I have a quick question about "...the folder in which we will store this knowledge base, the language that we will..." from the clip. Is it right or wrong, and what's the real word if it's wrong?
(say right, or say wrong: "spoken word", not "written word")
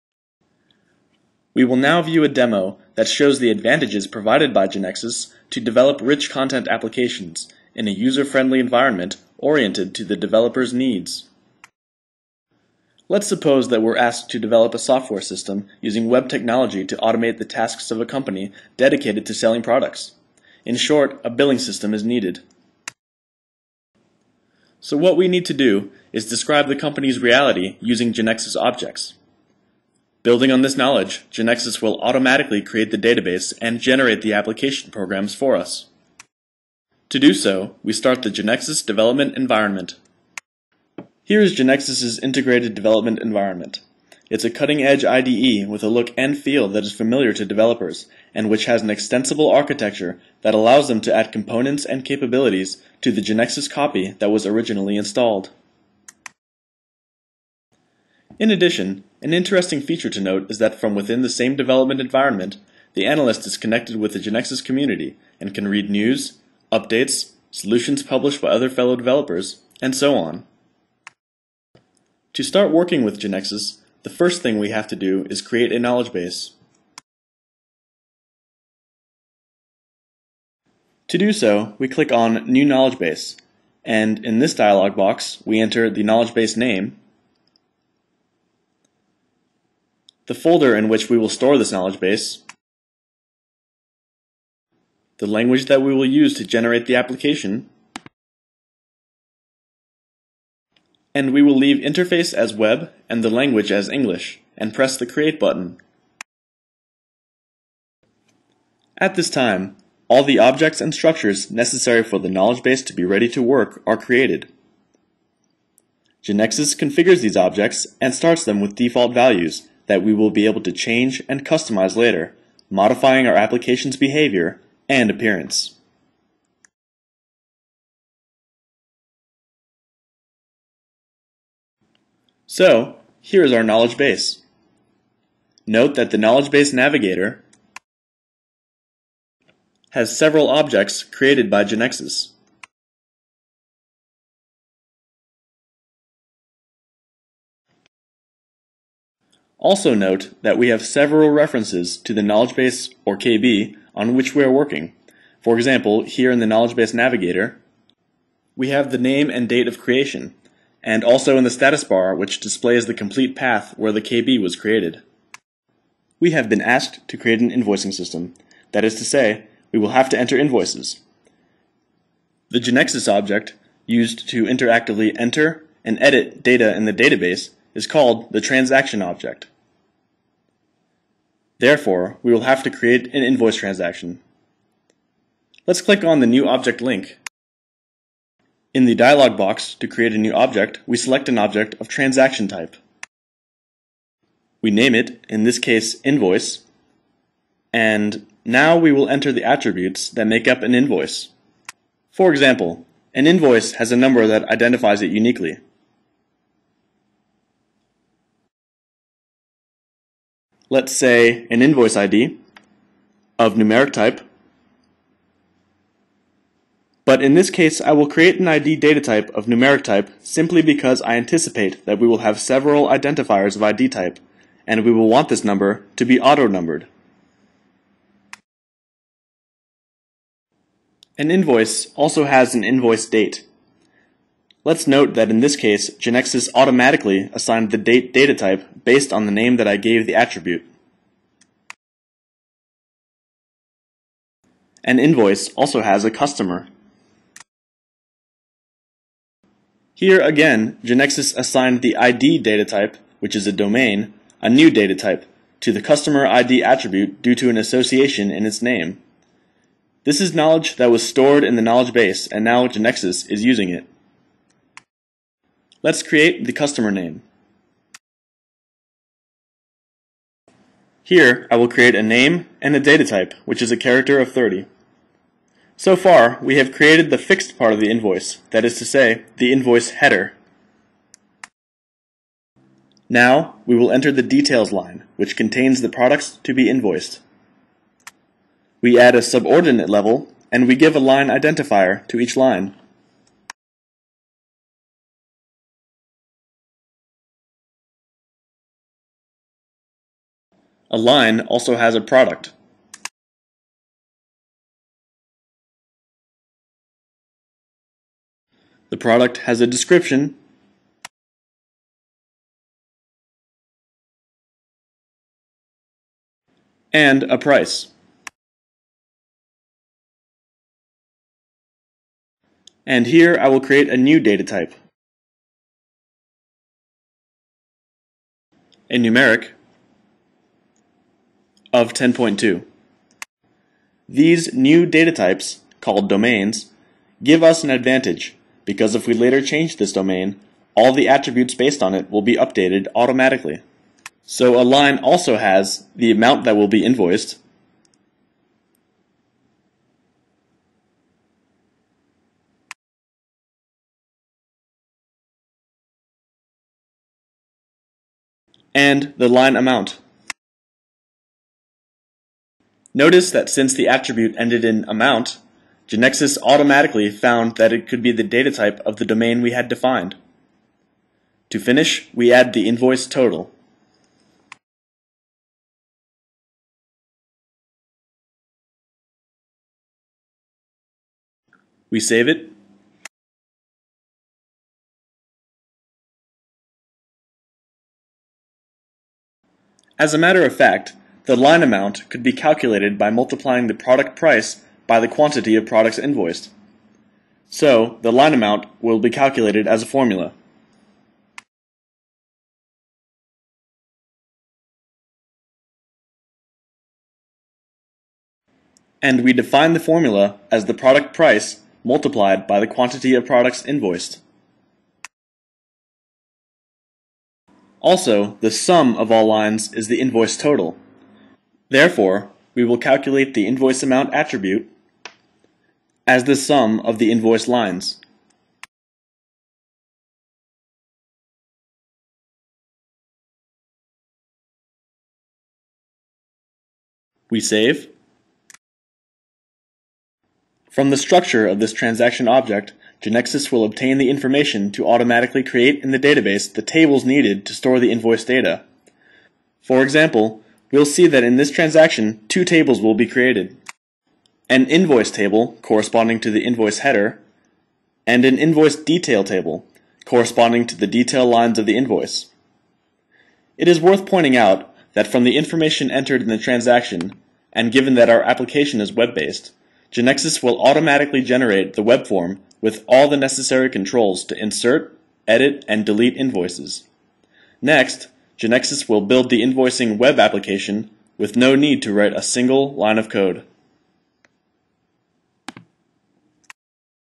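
right.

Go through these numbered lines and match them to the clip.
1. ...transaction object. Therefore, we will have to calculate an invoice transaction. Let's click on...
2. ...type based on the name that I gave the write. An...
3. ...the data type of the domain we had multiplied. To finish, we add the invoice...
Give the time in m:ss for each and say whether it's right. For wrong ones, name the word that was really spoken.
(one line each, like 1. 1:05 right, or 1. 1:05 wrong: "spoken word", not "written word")
1. 2:58 wrong: "create", not "calculate"
2. 3:58 wrong: "attribute", not "write"
3. 6:08 wrong: "defined", not "multiplied".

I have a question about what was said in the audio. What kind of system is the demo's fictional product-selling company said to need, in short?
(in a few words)
billing system.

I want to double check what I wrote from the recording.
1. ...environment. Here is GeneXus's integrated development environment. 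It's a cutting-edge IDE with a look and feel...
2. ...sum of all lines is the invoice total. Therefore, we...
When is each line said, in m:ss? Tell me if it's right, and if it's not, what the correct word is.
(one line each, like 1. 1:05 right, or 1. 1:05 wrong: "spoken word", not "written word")
1. 0:39 right
2. 6:58 right.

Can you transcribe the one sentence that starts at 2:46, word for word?
We have been asked to create an invoicing system.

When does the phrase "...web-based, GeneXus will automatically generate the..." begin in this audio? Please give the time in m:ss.
7:48.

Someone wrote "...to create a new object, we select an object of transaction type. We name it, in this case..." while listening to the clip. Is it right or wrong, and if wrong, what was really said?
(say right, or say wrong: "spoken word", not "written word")
right.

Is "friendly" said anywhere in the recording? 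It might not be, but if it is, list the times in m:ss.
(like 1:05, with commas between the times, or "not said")
0:07.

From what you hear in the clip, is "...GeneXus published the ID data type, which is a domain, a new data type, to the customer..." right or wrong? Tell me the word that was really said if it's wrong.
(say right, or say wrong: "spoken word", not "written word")
wrong: "assigned", not "published".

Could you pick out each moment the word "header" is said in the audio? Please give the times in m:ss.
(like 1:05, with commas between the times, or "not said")
4:39, 7:36.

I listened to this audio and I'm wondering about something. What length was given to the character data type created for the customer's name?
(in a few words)
30.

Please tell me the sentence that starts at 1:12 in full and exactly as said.
To start working with GeneXus, the first thing we have to do is create a knowledge base.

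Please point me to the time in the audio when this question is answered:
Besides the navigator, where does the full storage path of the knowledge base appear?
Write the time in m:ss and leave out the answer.
2:41.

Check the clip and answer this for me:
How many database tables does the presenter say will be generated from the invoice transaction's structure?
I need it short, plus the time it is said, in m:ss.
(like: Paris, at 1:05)
2, at 7:32.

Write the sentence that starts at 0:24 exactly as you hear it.
So what we need to do is describe the company's reality using GeneXus objects.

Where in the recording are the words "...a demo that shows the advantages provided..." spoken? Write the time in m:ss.
0:02.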